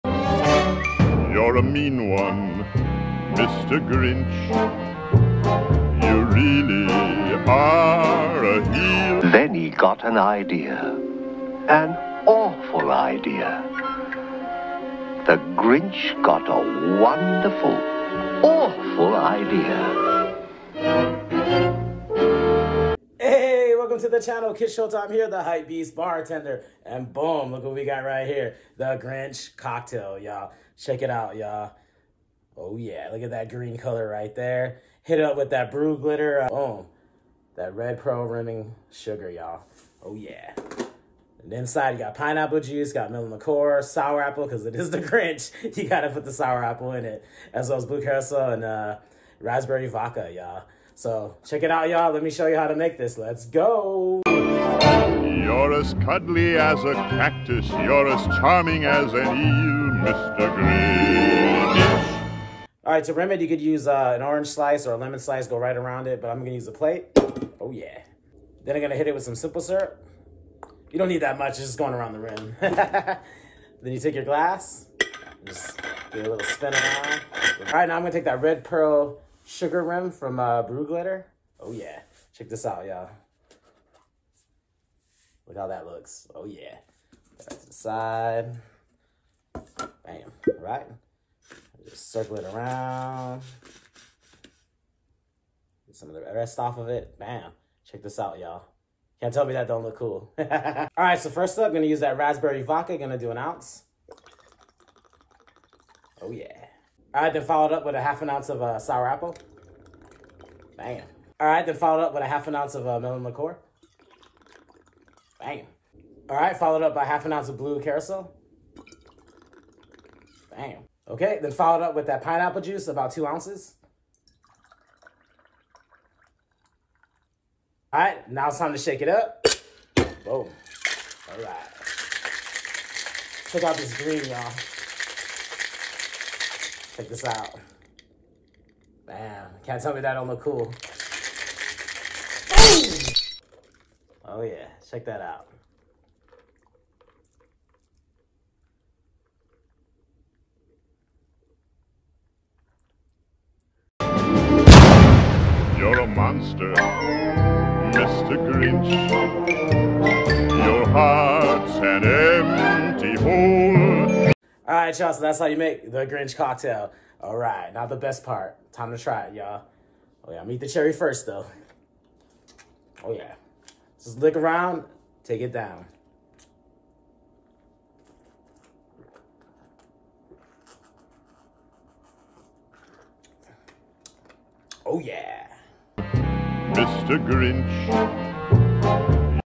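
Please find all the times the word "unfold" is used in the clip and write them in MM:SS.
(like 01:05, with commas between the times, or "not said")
not said.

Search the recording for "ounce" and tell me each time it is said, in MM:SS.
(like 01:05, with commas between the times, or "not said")
01:43, 01:48, 01:52, 01:57, 02:03.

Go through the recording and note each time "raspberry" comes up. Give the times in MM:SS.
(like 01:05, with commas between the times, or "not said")
00:49, 01:42.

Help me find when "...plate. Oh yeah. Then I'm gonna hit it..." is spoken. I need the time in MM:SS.
01:06.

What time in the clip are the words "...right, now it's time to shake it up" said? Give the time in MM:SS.
02:07.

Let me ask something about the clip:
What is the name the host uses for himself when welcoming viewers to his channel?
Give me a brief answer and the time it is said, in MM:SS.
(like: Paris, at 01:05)
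Kid Showtime, at 00:24.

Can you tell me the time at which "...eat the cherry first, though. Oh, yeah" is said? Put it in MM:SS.
02:50.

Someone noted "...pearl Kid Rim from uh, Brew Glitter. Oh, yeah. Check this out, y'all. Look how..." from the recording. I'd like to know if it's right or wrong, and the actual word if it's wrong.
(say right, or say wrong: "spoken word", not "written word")
wrong: "Sugar", not "Kid".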